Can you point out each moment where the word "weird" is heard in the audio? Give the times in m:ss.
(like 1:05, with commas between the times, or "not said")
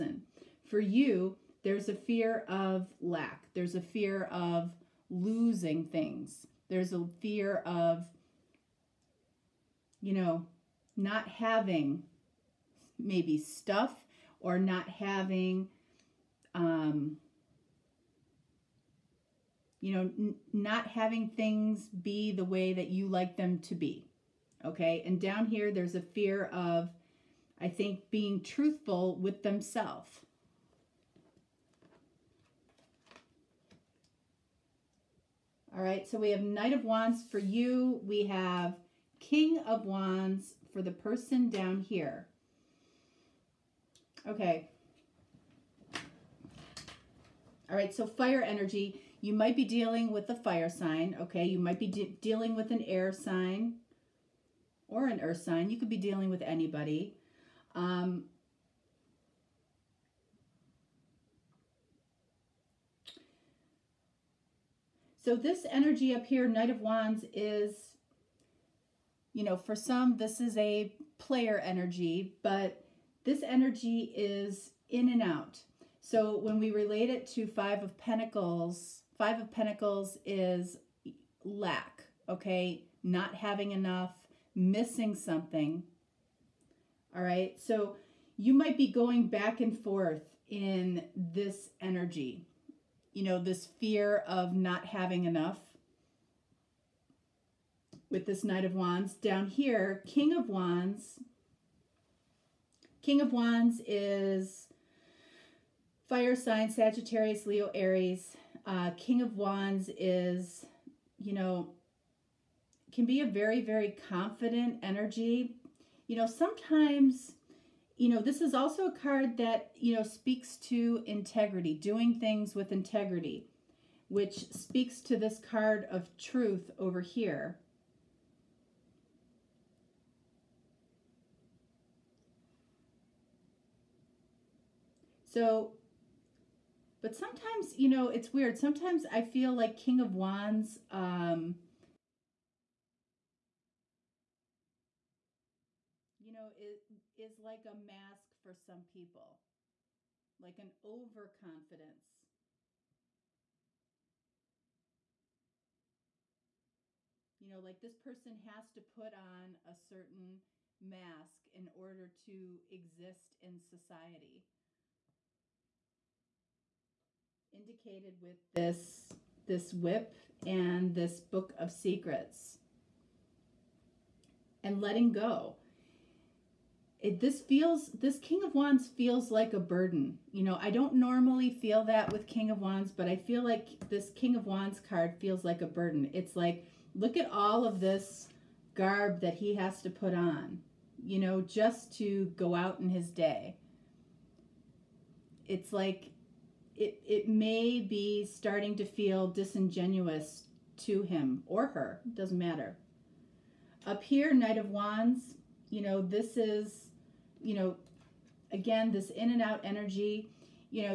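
2:18.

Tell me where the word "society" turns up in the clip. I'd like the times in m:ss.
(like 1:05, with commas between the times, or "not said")
2:43.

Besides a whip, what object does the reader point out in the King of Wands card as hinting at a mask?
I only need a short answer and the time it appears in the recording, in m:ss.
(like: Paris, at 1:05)
book of secrets, at 2:51.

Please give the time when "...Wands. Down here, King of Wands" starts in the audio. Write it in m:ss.
1:38.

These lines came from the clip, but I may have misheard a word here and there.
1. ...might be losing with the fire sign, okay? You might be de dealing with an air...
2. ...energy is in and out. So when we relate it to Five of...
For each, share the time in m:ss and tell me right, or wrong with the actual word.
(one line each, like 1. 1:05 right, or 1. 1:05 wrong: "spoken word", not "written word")
1. 0:49 wrong: "dealing", not "losing"
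2. 1:13 right.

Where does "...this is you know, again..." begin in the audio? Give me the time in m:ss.
3:26.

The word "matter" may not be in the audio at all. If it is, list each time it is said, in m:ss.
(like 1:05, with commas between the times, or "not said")
3:22.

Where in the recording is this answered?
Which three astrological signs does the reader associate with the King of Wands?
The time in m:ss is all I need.
1:46.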